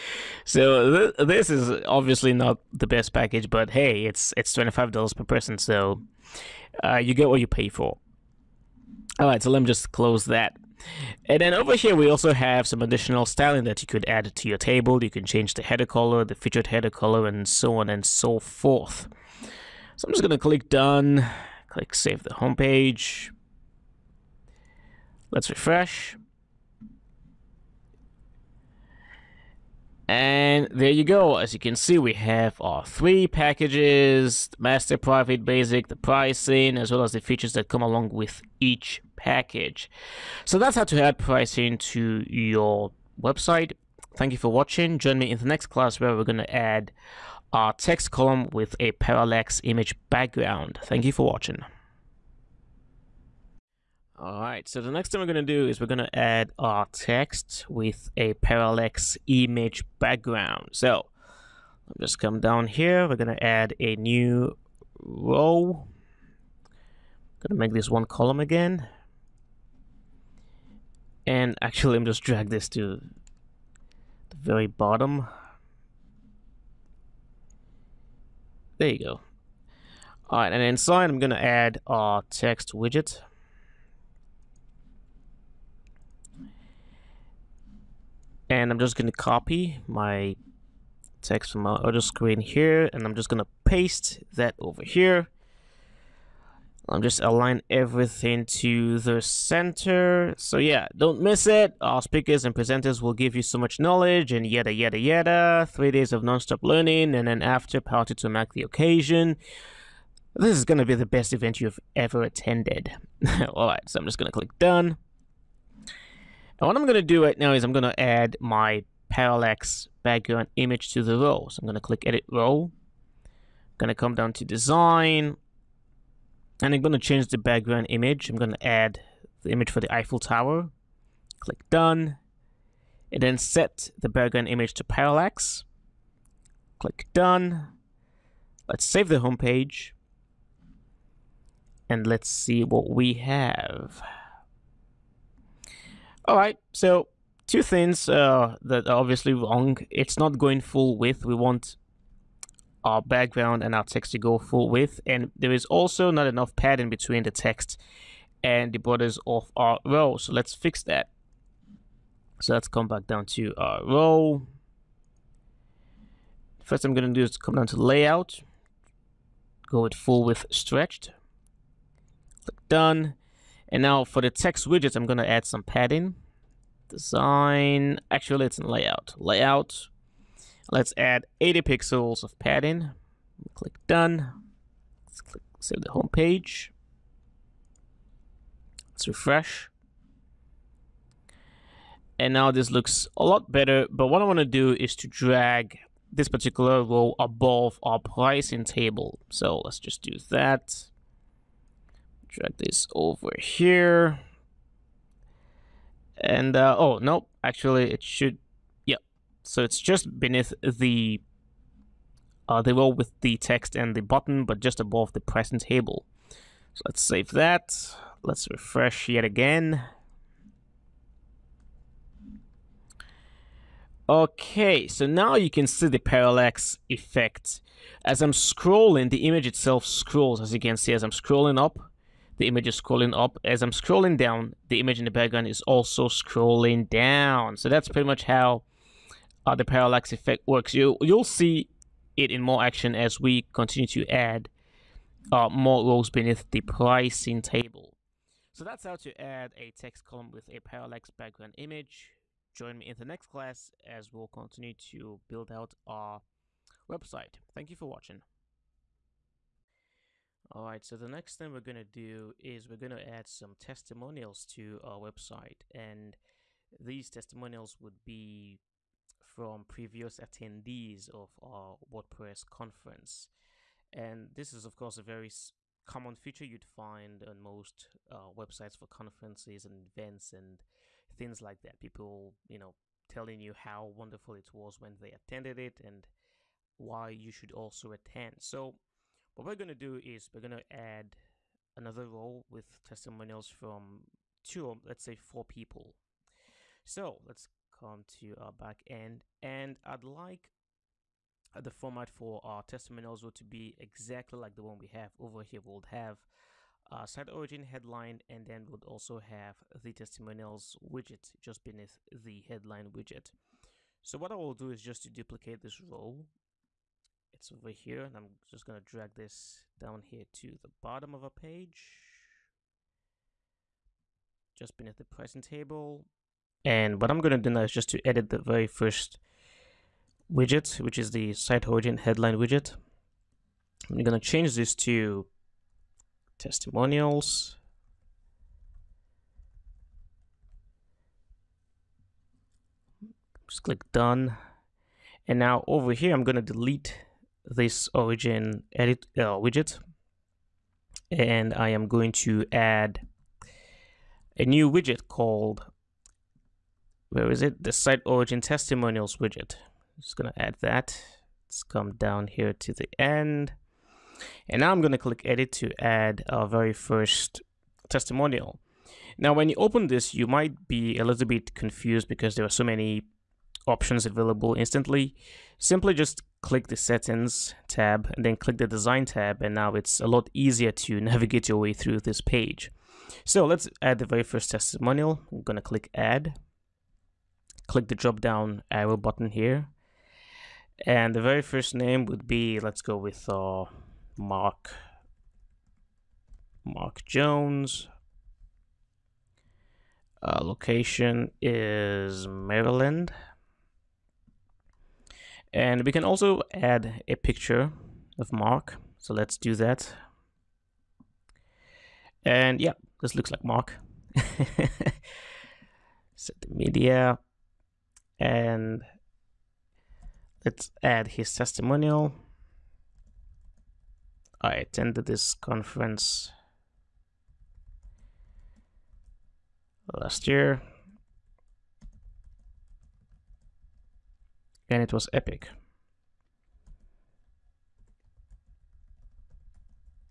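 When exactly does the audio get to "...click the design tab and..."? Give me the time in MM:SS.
06:18.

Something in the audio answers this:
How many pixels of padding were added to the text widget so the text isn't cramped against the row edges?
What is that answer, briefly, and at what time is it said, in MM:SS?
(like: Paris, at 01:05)
80, at 03:01.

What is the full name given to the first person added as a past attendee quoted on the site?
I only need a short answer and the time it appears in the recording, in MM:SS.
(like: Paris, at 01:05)
Mark Jones, at 06:36.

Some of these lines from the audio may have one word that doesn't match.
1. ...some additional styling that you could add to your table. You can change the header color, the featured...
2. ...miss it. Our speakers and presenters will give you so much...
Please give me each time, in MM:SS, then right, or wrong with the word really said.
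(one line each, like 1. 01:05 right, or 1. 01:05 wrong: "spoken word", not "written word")
1. 00:12 right
2. 01:41 right.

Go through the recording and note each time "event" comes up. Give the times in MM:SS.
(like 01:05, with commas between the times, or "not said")
01:51, 04:39.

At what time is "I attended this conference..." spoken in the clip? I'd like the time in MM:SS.
07:04.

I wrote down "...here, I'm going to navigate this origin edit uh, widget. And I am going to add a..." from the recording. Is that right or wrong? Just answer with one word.
wrong.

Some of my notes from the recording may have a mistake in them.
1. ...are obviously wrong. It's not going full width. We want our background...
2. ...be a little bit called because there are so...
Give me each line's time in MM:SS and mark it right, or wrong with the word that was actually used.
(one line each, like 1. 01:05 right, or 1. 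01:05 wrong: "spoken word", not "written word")
1. 02:28 right
2. 06:10 wrong: "confused", not "called".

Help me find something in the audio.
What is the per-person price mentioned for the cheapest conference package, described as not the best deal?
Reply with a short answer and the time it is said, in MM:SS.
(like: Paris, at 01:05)
$25, at 00:04.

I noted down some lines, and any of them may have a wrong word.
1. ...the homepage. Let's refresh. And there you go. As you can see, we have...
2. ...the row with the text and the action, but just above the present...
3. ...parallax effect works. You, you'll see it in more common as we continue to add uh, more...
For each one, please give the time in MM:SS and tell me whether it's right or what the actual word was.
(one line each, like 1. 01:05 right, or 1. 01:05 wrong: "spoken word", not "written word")
1. 00:22 right
2. 03:32 wrong: "button", not "action"
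3. 03:59 wrong: "action", not "common".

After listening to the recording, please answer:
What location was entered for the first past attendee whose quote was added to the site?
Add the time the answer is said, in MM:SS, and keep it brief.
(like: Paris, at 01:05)
Maryland, at 06:42.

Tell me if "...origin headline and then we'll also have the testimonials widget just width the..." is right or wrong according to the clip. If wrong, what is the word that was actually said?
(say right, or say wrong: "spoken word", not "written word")
wrong: "beneath", not "width".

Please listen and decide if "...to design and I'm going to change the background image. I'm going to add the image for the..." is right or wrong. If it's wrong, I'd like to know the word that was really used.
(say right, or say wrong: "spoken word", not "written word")
right.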